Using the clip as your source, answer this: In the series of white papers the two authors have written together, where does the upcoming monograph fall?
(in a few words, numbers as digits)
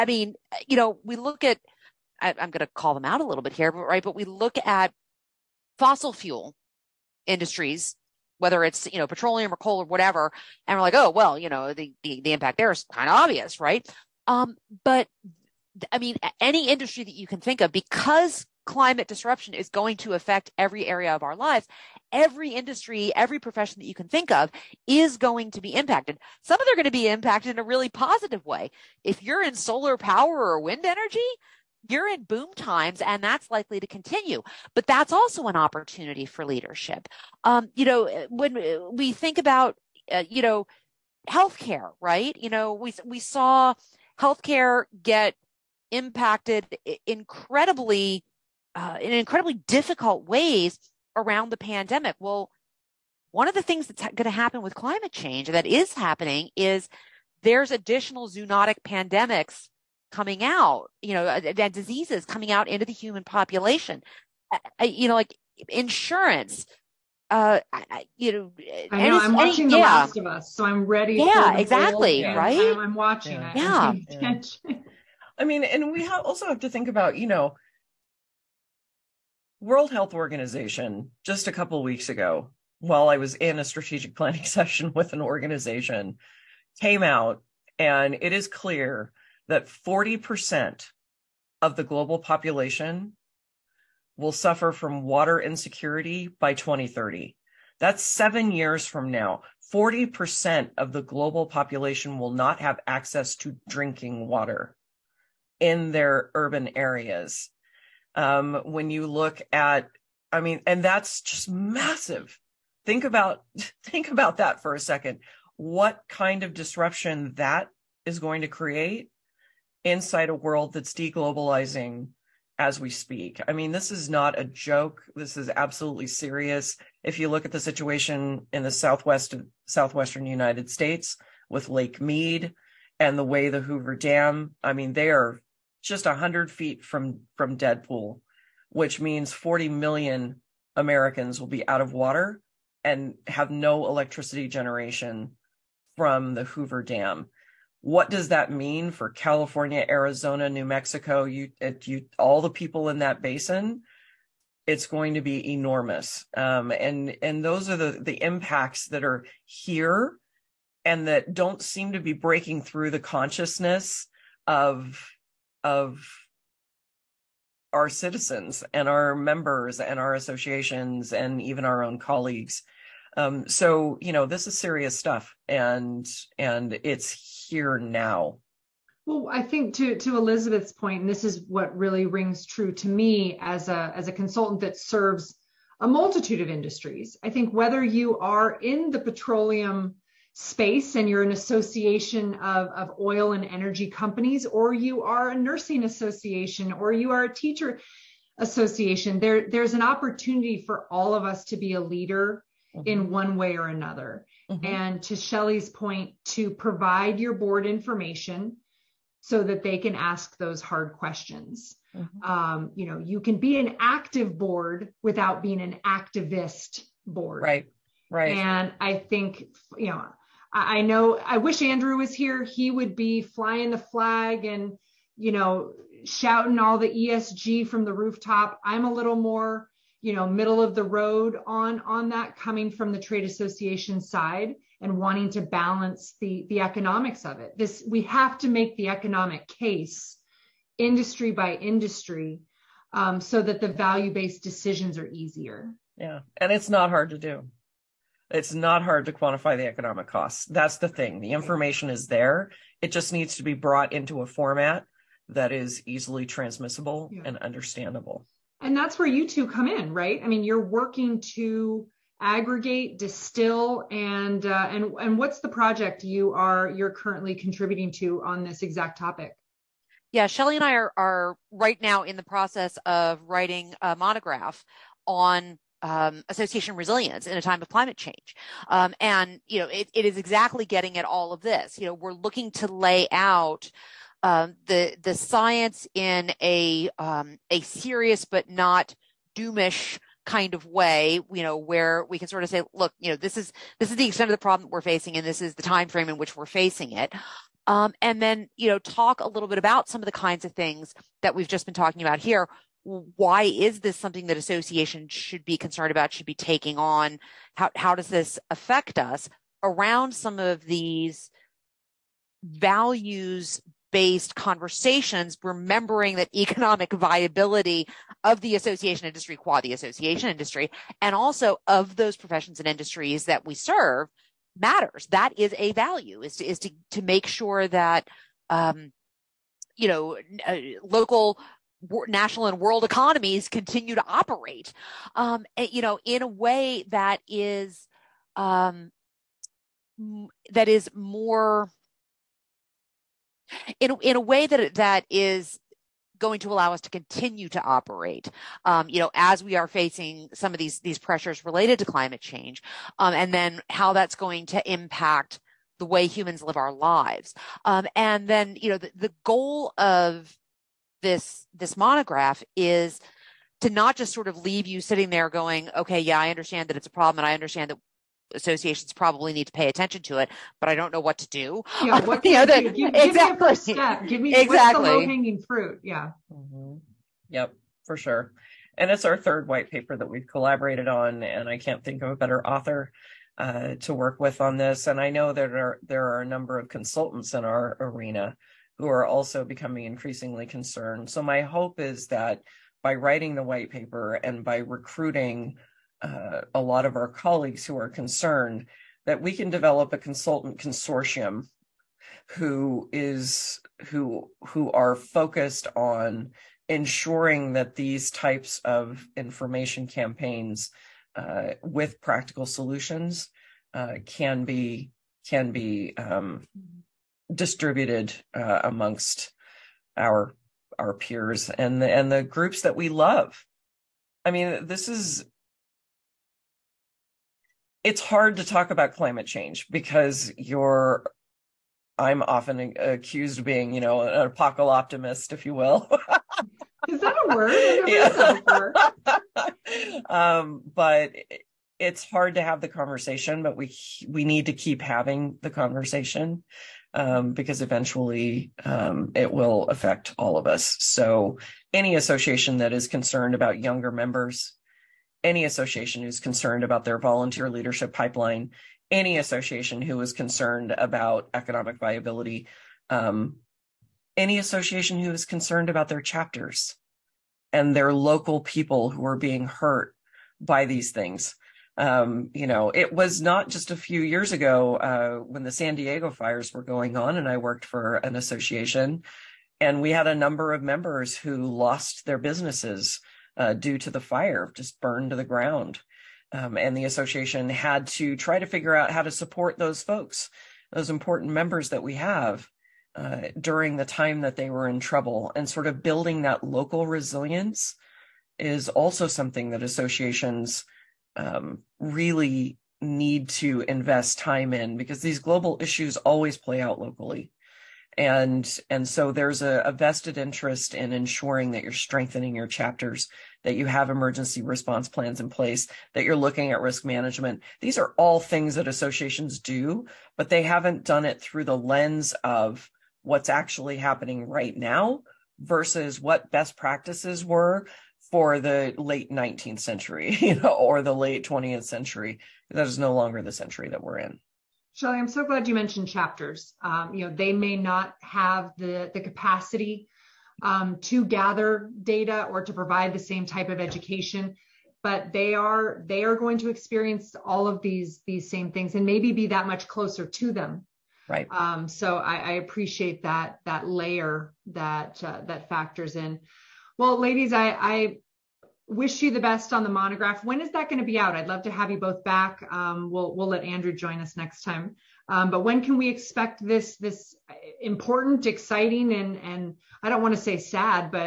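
third.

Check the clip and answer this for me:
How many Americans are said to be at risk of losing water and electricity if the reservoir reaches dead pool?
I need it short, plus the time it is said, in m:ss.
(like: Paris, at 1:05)
40 million, at 2:19.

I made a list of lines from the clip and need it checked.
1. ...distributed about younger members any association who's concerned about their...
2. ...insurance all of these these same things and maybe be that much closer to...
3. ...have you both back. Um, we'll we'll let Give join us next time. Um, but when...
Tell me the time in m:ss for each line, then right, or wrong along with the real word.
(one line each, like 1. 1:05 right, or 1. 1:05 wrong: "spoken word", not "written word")
1. 7:32 wrong: "concerned", not "distributed"
2. 9:06 wrong: "experience", not "insurance"
3. 9:21 wrong: "Andrew", not "Give".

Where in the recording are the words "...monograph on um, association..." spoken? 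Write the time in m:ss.
4:33.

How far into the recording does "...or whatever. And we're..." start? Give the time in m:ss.
0:09.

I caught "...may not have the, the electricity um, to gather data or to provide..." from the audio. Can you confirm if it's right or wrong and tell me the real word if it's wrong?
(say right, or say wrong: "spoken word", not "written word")
wrong: "capacity", not "electricity".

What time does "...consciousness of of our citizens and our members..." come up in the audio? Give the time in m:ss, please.
2:43.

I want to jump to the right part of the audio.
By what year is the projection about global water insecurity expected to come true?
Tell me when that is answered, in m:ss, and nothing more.
1:36.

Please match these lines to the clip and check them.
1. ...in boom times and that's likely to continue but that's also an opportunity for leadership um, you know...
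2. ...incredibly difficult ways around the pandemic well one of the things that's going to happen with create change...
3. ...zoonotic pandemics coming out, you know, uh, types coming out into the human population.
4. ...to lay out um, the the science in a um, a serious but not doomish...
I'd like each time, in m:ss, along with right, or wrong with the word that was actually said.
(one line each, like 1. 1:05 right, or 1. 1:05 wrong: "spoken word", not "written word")
1. 0:32 right
2. 0:49 wrong: "climate", not "create"
3. 0:58 wrong: "diseases", not "types"
4. 4:42 right.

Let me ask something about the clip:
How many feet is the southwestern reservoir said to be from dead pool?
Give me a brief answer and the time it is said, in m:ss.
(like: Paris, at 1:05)
100 feet, at 2:16.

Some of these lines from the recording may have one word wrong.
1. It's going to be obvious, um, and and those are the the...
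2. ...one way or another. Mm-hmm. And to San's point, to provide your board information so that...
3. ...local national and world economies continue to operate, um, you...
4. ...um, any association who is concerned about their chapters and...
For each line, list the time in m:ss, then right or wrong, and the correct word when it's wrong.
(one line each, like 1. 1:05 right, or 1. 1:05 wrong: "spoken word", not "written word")
1. 2:34 wrong: "enormous", not "obvious"
2. 3:23 wrong: "Shelly", not "San"
3. 5:30 right
4. 7:42 right.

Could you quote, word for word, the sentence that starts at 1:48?
Um, when you look at, I mean, and that's just massive.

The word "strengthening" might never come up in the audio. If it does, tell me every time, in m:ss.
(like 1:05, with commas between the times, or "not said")
8:31.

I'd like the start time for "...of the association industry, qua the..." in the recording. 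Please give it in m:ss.
5:18.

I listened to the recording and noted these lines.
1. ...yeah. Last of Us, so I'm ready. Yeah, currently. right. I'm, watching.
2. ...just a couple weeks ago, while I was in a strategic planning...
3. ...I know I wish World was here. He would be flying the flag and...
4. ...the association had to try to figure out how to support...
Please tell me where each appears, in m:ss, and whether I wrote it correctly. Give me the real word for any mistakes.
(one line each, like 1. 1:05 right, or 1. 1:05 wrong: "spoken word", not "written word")
1. 1:09 wrong: "exactly", not "currently"
2. 1:21 right
3. 3:40 wrong: "Andrew", not "World"
4. 8:06 right.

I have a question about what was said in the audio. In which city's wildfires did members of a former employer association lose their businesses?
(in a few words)
San Diego.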